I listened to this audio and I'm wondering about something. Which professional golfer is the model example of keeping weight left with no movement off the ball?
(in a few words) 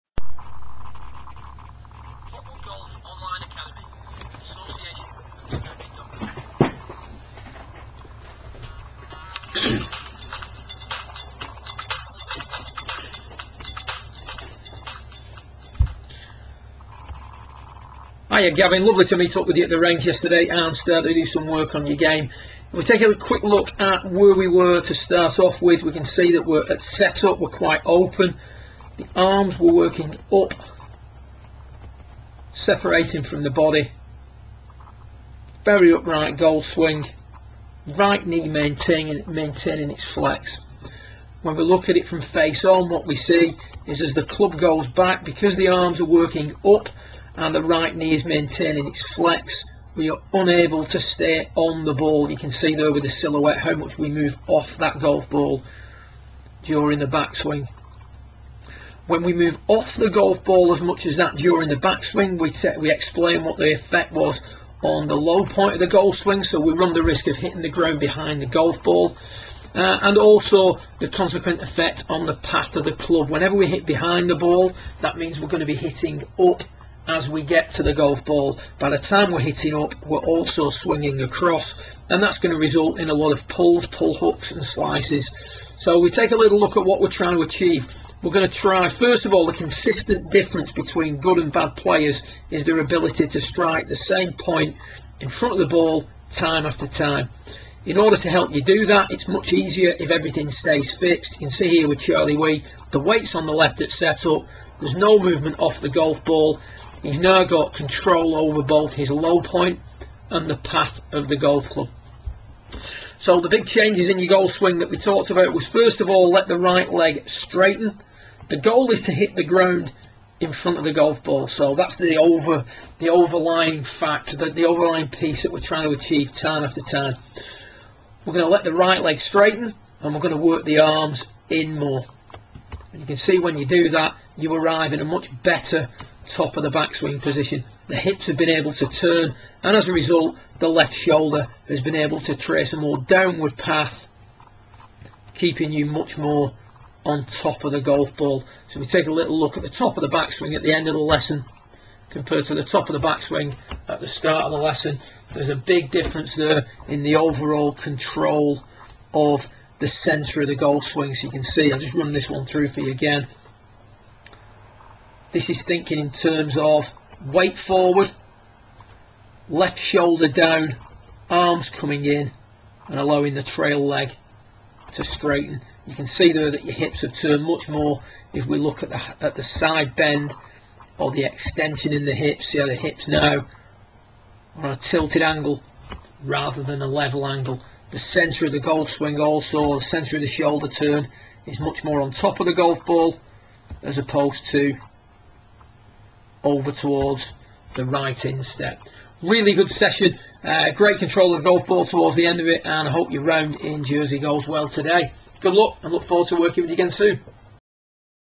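Charlie Wi.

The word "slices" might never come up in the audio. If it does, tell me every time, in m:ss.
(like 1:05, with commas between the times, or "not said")
1:24.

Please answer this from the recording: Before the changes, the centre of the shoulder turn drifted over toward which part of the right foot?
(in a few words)
right instep.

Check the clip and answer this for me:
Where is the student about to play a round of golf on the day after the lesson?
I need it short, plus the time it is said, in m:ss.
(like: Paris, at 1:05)
Jersey, at 3:23.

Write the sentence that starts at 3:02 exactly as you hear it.
See how the hips now are on a tilted angle rather than a level angle.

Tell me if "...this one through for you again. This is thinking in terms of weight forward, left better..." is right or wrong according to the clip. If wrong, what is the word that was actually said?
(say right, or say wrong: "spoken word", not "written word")
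wrong: "shoulder", not "better".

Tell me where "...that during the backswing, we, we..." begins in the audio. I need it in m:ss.
1:01.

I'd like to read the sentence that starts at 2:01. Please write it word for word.
So that's the over the overlying fact, the, the overlying piece that we're trying to achieve time after time.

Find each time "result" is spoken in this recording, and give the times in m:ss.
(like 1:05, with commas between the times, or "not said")
1:22, 2:19.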